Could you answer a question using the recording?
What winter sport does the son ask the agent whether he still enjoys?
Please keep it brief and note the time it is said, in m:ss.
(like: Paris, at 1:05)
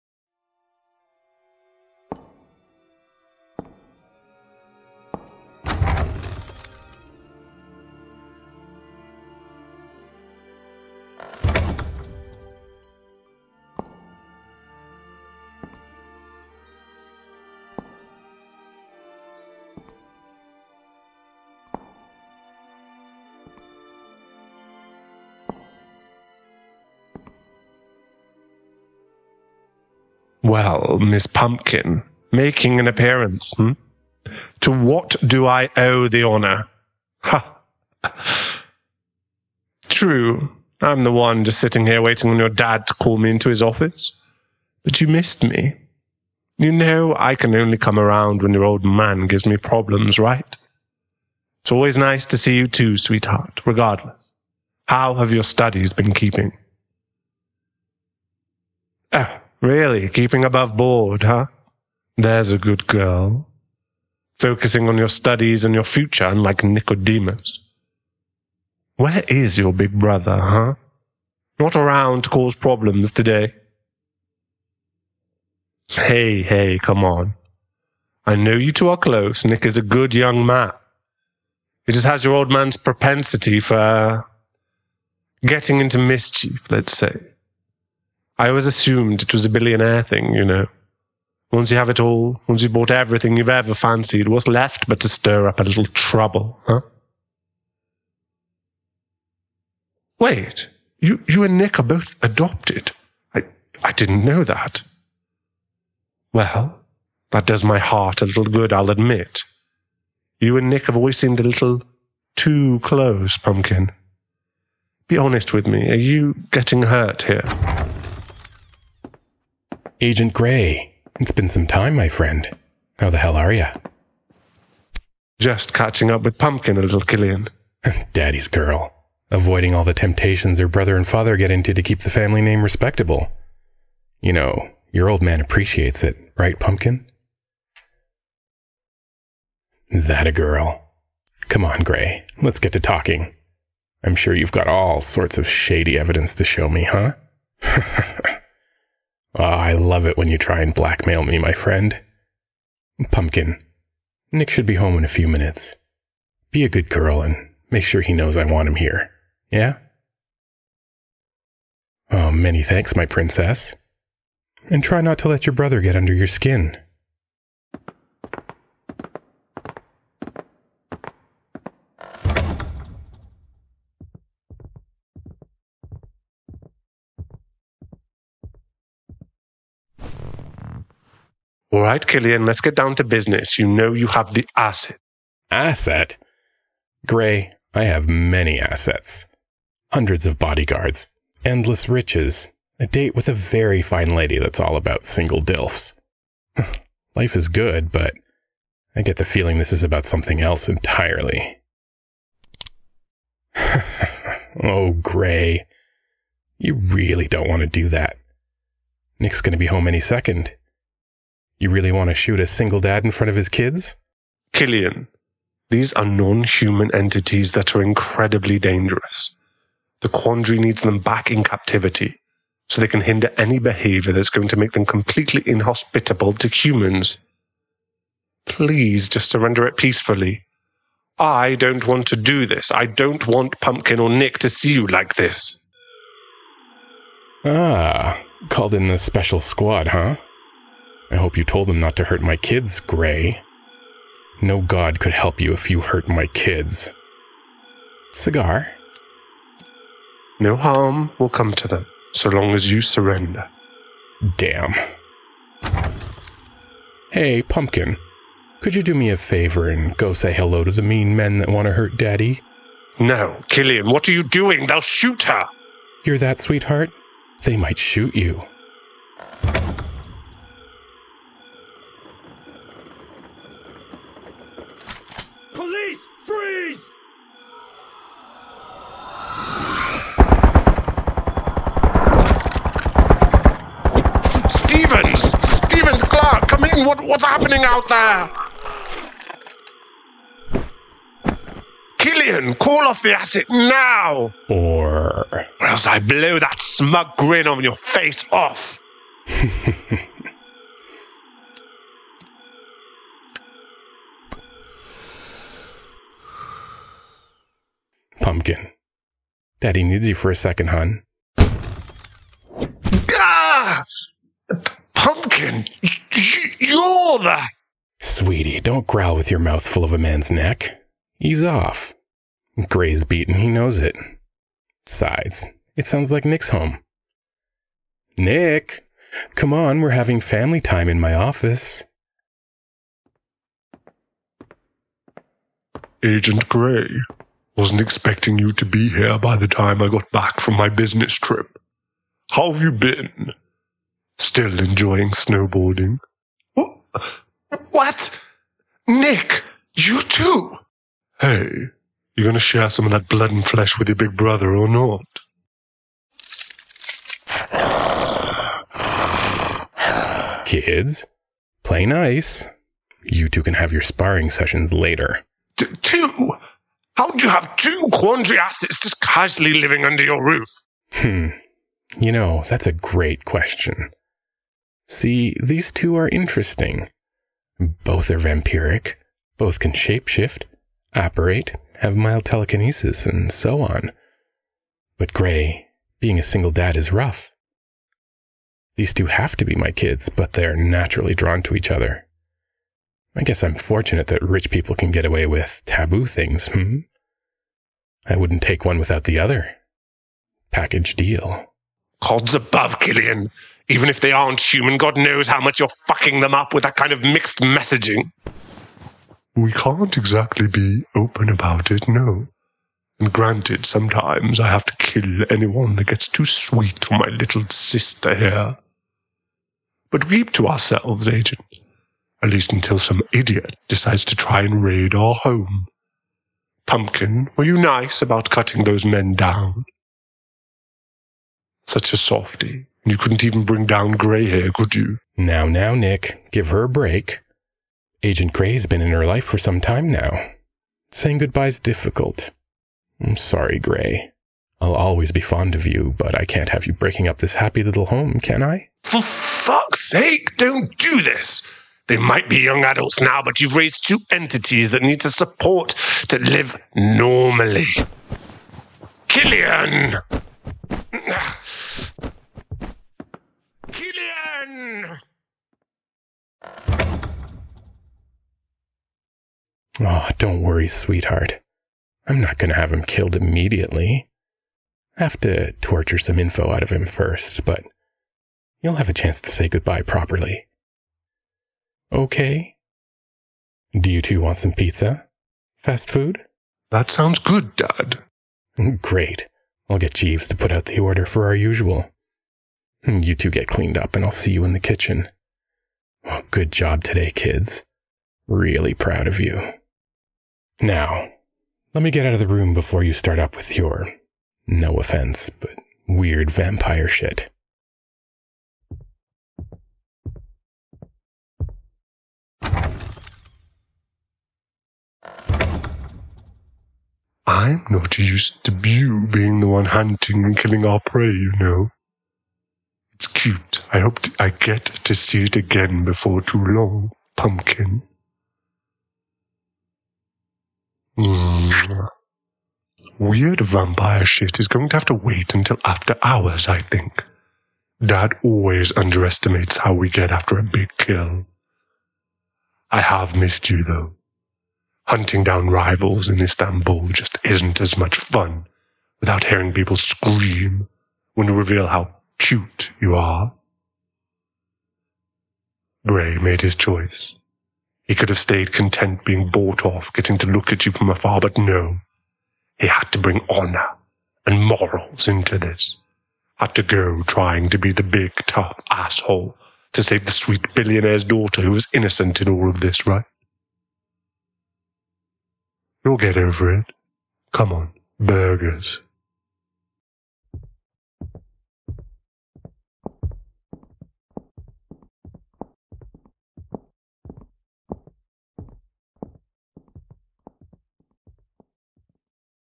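Snowboarding, at 5:45.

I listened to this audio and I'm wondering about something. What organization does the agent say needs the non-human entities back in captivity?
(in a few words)
The quandary.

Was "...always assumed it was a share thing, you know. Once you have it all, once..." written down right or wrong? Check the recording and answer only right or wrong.
wrong.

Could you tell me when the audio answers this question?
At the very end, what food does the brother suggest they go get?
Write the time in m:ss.
9:37.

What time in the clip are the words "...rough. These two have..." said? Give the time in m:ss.
6:26.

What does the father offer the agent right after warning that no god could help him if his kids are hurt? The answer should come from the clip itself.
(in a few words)
Cigar.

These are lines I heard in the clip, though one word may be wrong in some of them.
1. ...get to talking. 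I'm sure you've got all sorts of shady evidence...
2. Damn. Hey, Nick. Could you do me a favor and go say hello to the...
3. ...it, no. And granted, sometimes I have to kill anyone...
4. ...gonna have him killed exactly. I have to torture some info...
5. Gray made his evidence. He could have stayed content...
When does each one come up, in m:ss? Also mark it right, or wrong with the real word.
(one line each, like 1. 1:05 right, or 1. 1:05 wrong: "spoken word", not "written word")
1. 2:22 right
2. 4:14 wrong: "Pumpkin", not "Nick"
3. 6:51 right
4. 7:52 wrong: "immediately", not "exactly"
5. 9:15 wrong: "choice", not "evidence".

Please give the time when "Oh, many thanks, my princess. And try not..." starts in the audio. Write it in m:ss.
2:42.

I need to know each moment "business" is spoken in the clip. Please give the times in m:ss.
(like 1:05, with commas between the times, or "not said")
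3:03, 5:40.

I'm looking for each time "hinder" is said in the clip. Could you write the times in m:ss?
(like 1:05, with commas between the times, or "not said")
3:43.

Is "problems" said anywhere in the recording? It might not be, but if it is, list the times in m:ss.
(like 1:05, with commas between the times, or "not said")
0:49, 1:12.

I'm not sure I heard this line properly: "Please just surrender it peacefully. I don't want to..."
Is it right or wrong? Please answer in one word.
right.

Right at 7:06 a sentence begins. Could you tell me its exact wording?
Pumpkin, were you nice about cutting those men down?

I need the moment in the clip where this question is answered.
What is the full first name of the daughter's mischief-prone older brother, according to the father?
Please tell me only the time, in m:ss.
1:06.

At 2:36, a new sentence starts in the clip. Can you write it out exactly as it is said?
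Be a good girl and make sure he knows I want him here.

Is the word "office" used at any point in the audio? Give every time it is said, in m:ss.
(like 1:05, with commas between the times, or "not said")
0:43, 5:31.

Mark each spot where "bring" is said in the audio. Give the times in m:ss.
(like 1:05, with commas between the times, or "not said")
7:13, 9:22.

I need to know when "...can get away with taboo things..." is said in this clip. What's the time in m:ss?
6:34.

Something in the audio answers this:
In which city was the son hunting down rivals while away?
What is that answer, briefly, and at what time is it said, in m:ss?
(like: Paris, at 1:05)
Istanbul, at 9:06.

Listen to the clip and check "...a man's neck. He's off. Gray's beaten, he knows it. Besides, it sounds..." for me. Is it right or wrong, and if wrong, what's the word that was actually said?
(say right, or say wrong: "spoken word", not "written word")
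right.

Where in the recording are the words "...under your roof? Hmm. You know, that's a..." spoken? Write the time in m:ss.
6:09.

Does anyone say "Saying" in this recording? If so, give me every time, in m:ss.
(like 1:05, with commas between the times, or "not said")
7:20.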